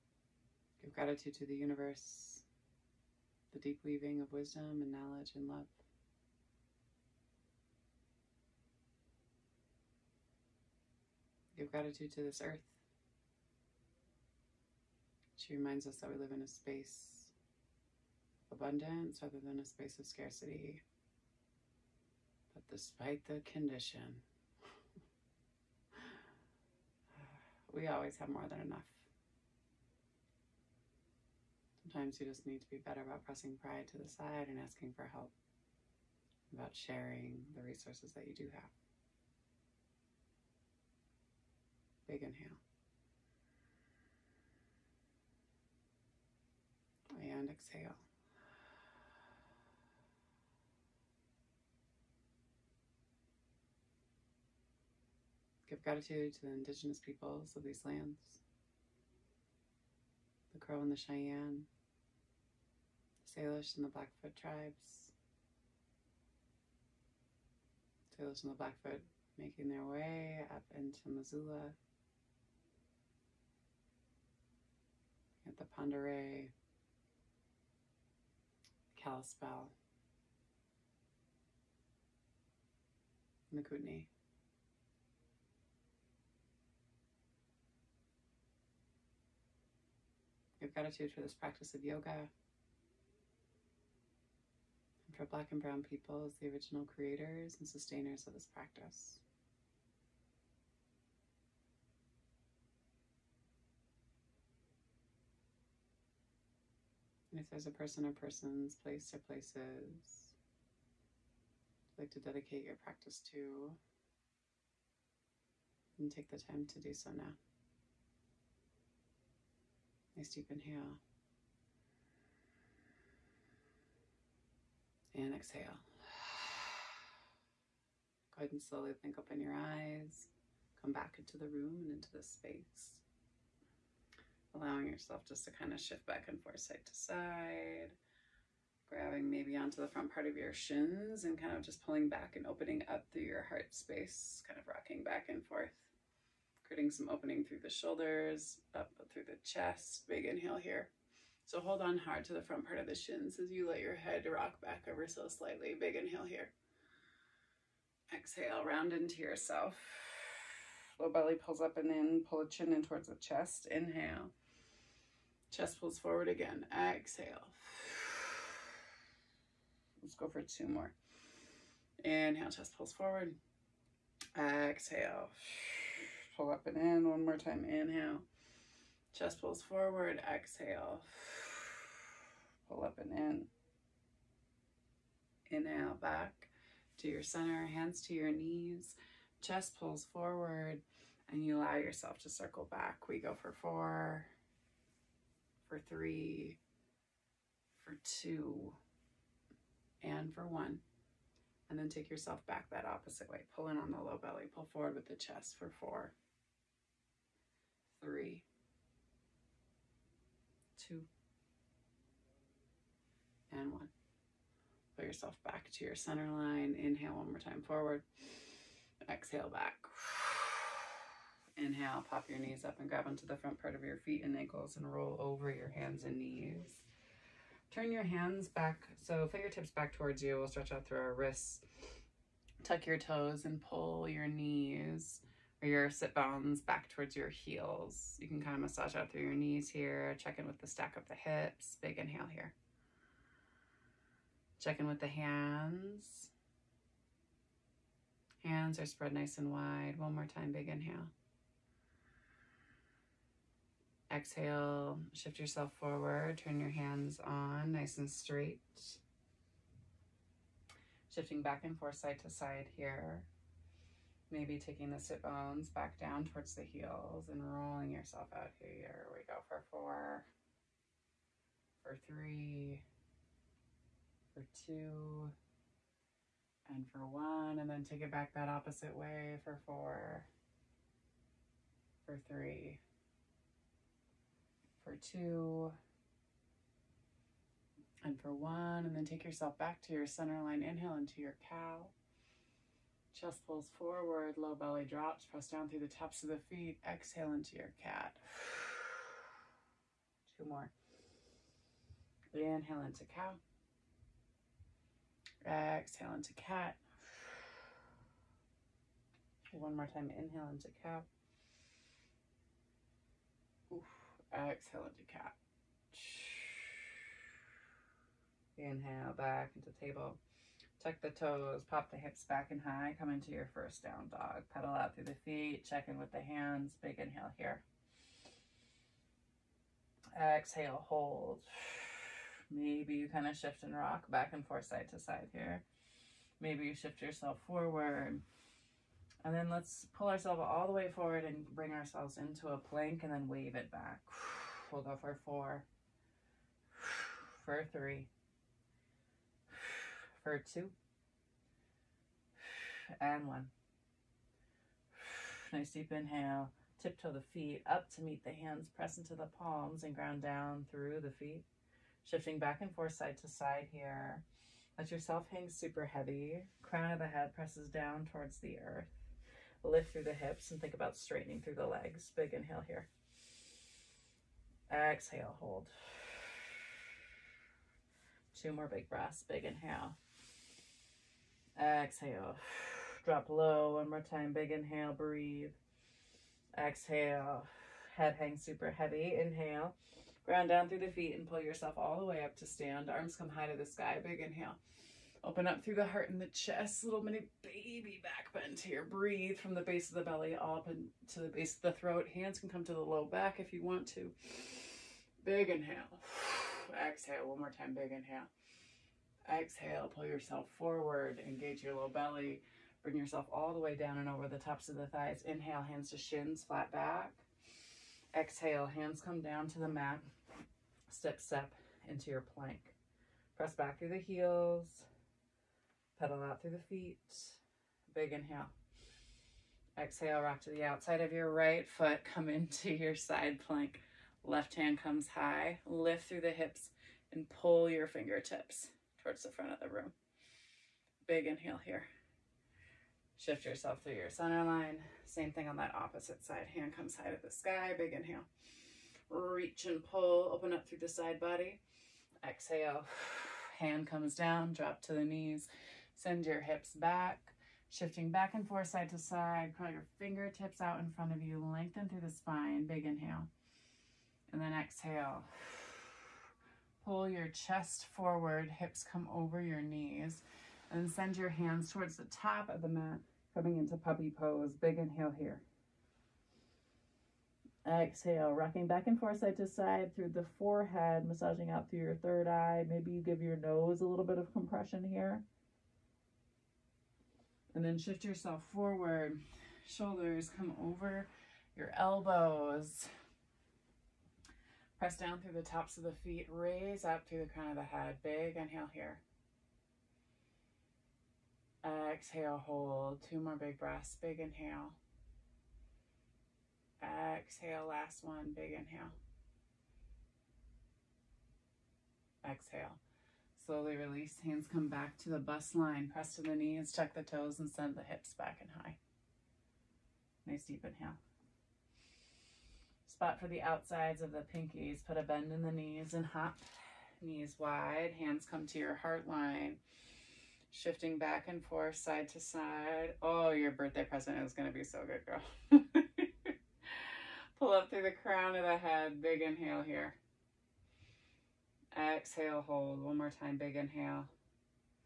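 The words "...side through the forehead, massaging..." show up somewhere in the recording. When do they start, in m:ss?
7:59.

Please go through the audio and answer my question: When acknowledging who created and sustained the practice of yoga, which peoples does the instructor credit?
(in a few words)
Black and Brown people.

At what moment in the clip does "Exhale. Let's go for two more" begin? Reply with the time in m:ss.
2:46.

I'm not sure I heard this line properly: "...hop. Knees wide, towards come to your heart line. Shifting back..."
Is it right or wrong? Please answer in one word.
wrong.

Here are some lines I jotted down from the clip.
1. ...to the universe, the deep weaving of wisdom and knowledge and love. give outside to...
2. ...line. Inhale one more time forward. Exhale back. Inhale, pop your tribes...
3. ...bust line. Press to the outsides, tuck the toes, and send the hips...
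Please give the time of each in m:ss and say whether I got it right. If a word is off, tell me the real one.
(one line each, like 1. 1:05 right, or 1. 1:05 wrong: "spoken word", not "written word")
1. 0:01 wrong: "gratitude", not "outside"
2. 3:36 wrong: "knees", not "tribes"
3. 8:35 wrong: "knees", not "outsides".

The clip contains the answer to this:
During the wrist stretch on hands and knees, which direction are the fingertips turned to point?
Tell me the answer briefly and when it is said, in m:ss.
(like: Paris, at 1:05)
back towards you, at 3:49.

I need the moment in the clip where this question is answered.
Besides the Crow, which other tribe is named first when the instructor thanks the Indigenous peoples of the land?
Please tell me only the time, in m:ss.
1:00.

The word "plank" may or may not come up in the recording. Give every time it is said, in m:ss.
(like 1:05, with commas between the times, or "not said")
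5:42, 7:02, 7:13.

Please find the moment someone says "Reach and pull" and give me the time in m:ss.
7:29.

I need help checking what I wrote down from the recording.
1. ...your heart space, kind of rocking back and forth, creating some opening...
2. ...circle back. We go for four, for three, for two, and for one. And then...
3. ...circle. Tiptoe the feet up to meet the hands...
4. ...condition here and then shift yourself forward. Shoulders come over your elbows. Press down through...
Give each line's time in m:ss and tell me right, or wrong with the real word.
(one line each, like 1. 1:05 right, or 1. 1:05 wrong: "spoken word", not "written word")
1. 2:23 right
2. 3:12 right
3. 5:55 wrong: "inhale", not "circle"
4. 8:04 wrong: "compression", not "condition".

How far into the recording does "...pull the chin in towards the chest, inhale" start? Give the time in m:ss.
2:42.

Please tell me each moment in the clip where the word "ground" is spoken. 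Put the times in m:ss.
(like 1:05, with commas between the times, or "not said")
5:59, 6:30.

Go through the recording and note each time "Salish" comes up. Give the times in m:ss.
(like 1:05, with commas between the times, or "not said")
1:03, 1:08.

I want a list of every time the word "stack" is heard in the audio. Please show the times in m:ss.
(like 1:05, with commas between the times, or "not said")
4:00.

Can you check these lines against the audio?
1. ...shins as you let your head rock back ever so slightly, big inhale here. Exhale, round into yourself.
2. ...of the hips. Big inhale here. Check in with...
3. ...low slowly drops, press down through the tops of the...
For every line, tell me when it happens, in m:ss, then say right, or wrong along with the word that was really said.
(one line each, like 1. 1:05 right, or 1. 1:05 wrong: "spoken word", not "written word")
1. 2:32 right
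2. 4:00 right
3. 4:54 wrong: "belly", not "slowly".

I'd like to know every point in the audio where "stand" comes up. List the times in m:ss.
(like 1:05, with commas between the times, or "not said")
6:32.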